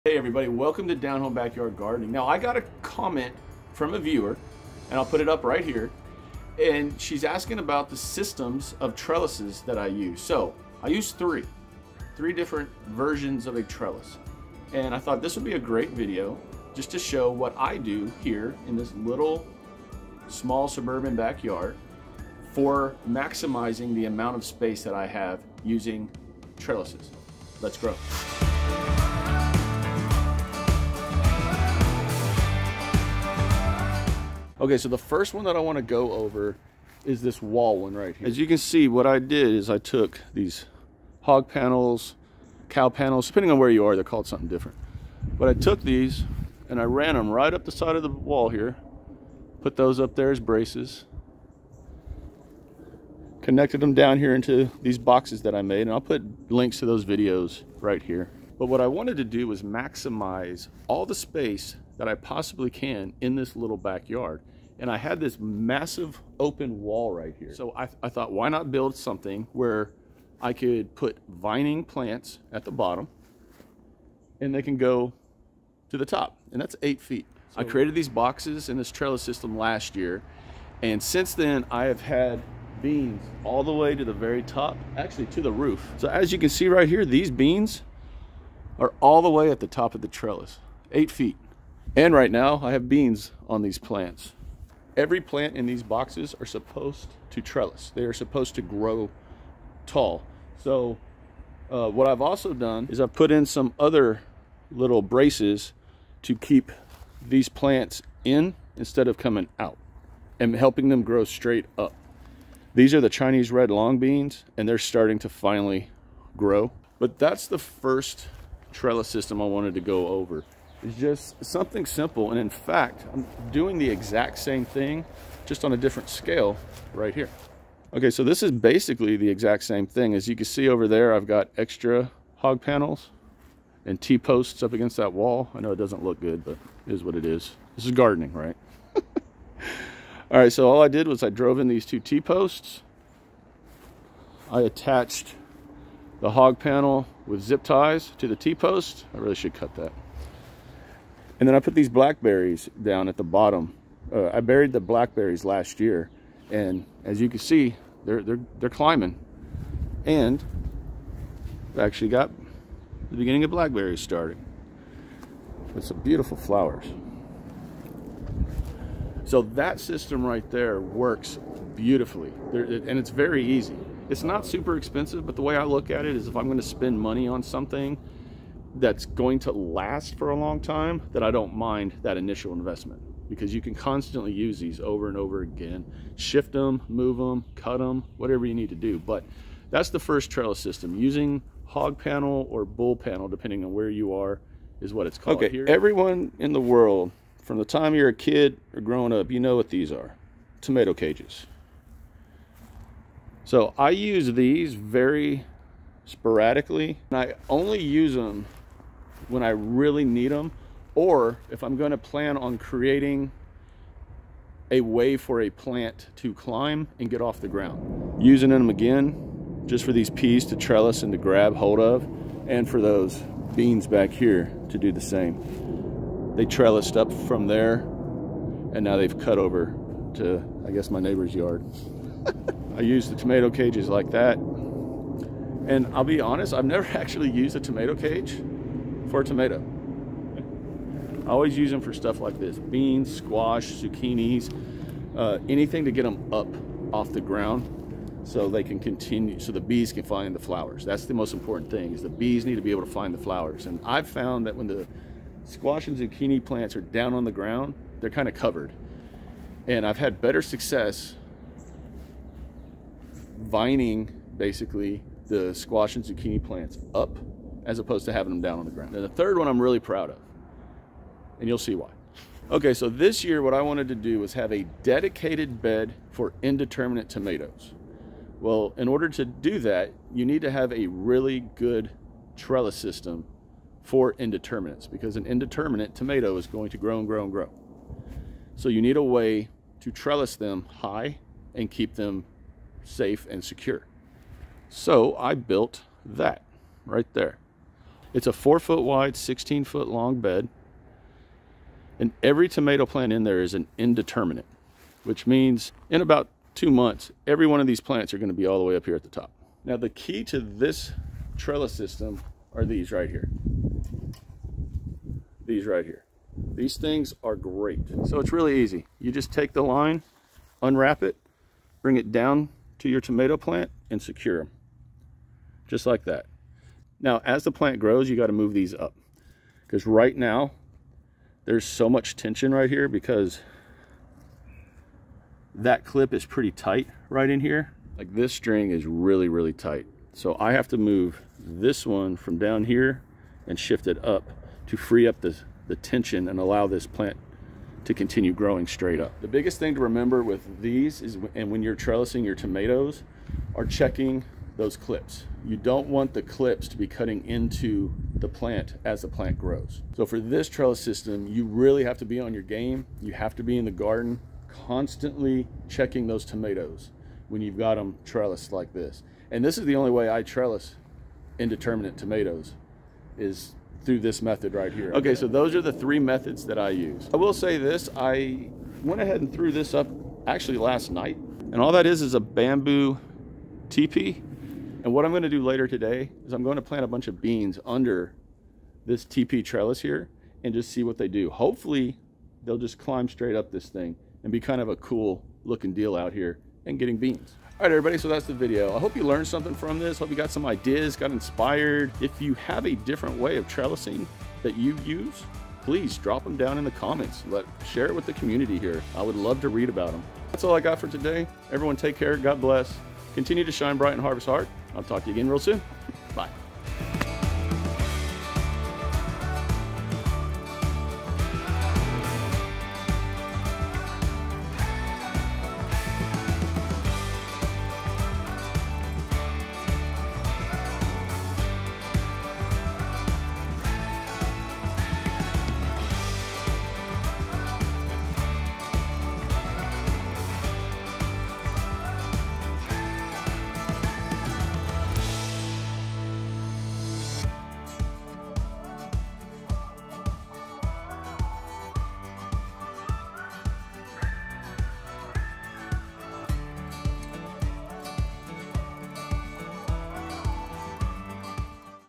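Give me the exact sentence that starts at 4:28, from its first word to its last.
And the third one I'm really proud of, and you'll see why.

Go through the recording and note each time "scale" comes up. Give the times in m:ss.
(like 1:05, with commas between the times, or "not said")
2:06.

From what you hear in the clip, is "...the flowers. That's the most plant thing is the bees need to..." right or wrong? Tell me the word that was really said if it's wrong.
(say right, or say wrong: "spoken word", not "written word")
wrong: "important", not "plant".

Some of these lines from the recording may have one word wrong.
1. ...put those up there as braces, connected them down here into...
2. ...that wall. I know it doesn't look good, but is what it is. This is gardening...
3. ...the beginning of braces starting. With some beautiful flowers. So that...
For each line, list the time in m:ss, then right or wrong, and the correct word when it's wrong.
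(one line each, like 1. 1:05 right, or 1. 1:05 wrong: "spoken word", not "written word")
1. 0:49 right
2. 2:14 right
3. 2:43 wrong: "blackberries", not "braces".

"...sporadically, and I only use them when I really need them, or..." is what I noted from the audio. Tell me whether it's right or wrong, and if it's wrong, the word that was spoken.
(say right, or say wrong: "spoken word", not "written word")
right.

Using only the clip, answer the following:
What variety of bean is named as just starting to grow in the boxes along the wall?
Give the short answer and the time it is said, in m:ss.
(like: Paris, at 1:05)
Chinese red long beans, at 1:53.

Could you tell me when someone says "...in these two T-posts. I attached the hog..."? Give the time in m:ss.
2:21.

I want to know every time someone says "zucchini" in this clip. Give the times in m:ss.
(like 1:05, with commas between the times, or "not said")
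4:03, 4:15, 4:26.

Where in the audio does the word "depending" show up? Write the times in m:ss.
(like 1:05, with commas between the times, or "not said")
0:43, 3:13.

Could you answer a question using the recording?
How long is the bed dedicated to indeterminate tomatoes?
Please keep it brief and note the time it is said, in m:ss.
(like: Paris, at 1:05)
16 feet, at 4:59.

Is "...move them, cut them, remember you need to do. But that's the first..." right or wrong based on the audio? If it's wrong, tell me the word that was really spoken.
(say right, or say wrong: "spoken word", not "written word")
wrong: "whatever", not "remember".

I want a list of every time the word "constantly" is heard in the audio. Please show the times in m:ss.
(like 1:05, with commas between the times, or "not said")
3:03, 6:04.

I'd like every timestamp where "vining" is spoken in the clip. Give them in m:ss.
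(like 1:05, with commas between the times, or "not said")
1:11, 4:23.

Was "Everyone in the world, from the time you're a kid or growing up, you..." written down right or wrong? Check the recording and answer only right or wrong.
right.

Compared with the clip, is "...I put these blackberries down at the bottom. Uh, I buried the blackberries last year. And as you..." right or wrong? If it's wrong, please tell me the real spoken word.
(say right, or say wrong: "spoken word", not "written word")
right.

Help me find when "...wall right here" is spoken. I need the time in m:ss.
1:06.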